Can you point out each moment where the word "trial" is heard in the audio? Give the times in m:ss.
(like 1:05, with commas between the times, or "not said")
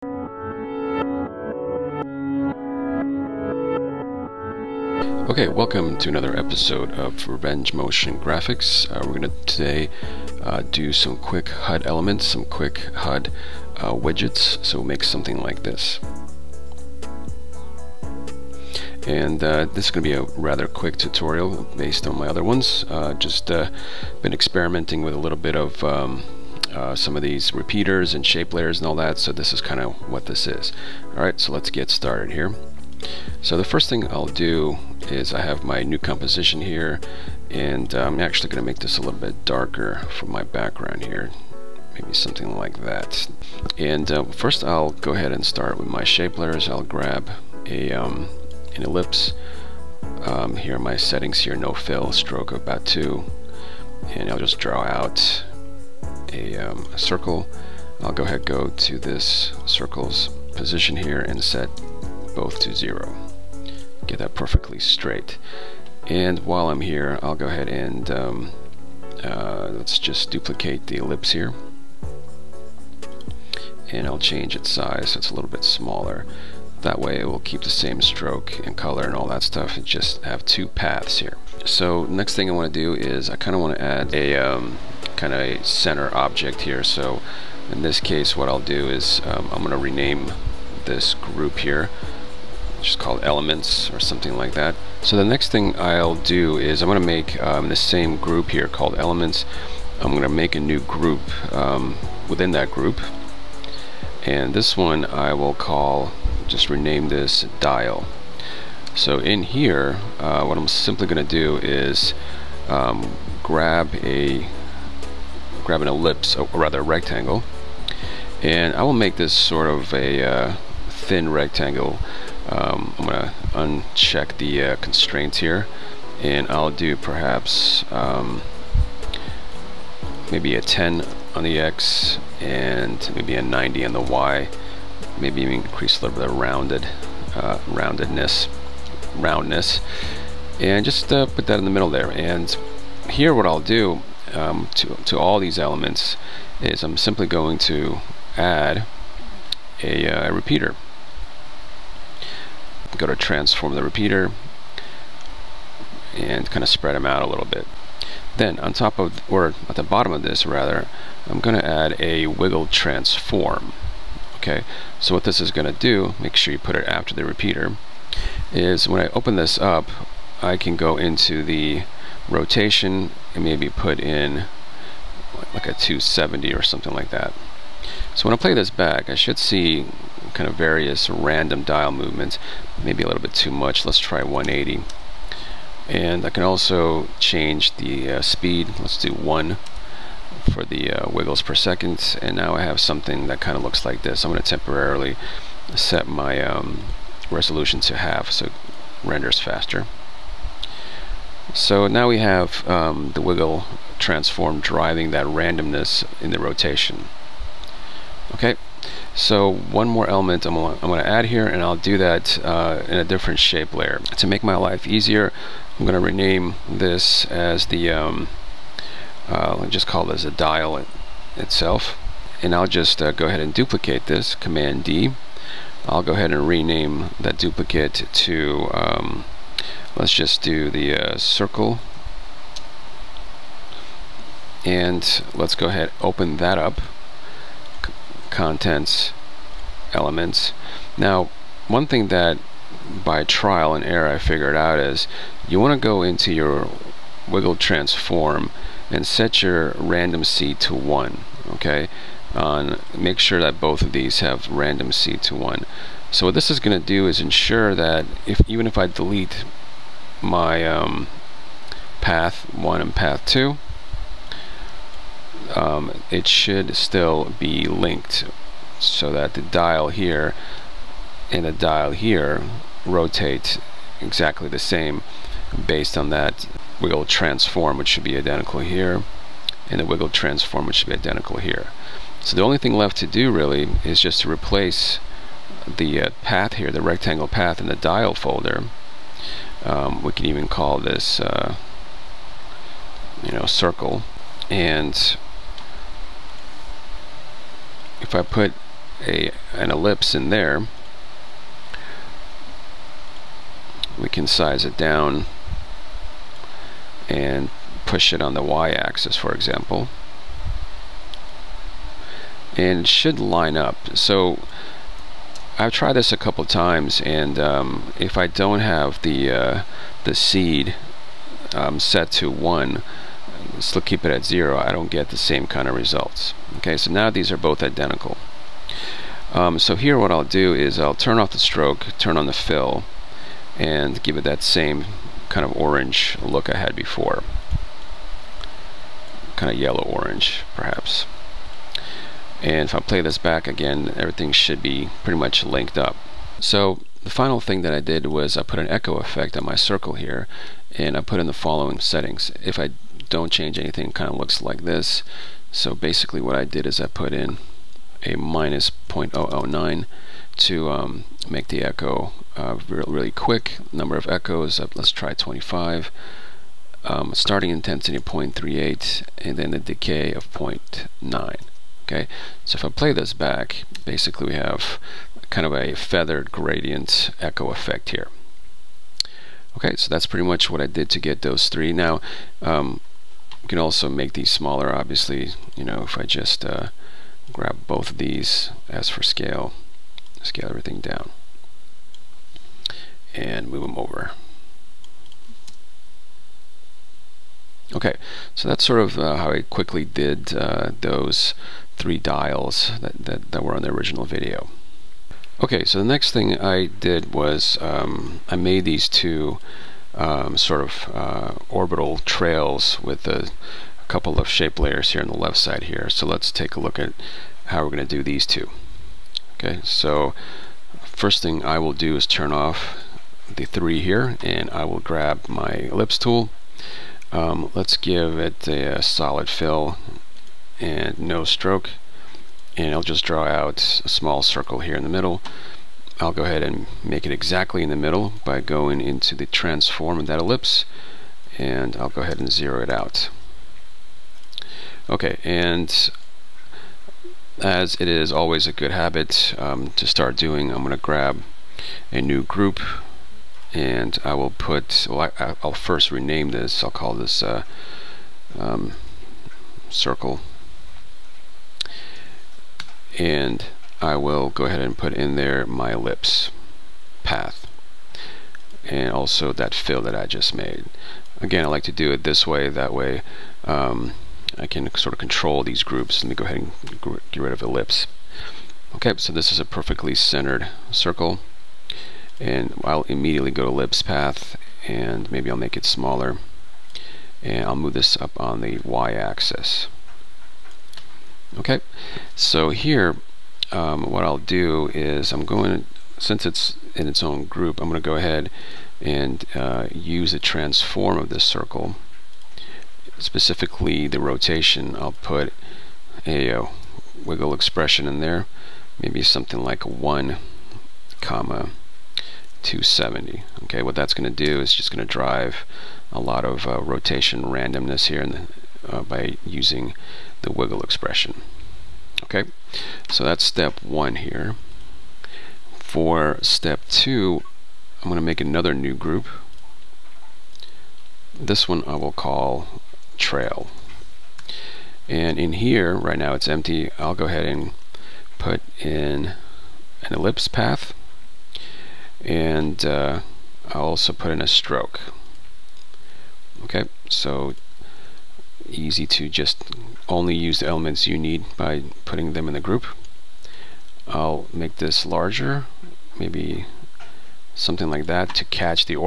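4:03.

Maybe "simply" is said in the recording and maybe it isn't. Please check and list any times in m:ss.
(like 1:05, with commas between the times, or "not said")
1:50, 2:26.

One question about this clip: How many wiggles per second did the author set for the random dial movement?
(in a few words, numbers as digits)
1.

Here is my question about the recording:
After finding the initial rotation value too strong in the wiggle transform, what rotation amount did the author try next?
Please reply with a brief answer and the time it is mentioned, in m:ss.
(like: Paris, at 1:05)
180, at 3:03.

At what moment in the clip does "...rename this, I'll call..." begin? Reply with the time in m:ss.
7:35.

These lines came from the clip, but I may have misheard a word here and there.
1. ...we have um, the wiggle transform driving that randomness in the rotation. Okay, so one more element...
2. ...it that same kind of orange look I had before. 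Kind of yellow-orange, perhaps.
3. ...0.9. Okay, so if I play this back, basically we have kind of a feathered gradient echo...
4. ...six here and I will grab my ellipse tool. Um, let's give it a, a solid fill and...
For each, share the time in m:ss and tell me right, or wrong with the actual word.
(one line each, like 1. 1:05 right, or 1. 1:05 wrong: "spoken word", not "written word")
1. 3:22 right
2. 5:34 right
3. 6:10 right
4. 7:03 wrong: "three", not "six".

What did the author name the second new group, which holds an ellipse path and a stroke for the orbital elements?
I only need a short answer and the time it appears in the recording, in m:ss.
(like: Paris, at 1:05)
trail, at 8:52.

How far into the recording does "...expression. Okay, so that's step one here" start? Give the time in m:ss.
8:40.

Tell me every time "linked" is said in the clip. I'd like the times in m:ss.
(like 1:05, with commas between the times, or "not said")
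4:27, 5:45.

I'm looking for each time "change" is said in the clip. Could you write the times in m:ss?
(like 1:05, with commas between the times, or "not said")
1:14, 3:07, 5:53.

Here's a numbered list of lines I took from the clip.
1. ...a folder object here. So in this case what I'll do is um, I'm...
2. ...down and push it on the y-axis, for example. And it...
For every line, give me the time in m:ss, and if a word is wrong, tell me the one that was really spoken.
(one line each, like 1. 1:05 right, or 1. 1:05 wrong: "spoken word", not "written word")
1. 1:25 wrong: "center", not "folder"
2. 5:04 right.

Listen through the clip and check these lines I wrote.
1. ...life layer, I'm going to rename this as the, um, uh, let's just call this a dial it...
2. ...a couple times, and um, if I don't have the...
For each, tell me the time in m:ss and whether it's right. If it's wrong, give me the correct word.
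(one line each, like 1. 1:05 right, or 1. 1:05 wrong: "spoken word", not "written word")
1. 3:34 wrong: "easier", not "layer"
2. 5:16 right.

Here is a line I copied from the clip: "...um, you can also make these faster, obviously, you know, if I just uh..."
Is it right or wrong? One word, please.
wrong.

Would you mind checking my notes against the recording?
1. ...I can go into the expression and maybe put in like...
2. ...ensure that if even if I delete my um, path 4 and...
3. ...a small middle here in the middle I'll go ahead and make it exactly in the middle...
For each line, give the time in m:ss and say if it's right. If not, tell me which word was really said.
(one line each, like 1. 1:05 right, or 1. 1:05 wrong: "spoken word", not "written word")
1. 2:50 wrong: "rotation", not "expression"
2. 4:17 wrong: "1", not "4"
3. 7:13 wrong: "circle", not "middle".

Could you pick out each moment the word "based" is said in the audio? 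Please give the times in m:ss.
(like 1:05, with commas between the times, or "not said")
0:21, 4:35.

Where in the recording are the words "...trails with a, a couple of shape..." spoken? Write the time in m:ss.
6:51.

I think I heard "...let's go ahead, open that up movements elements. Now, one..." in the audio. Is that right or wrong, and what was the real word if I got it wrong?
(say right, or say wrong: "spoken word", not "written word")
wrong: "contents", not "movements".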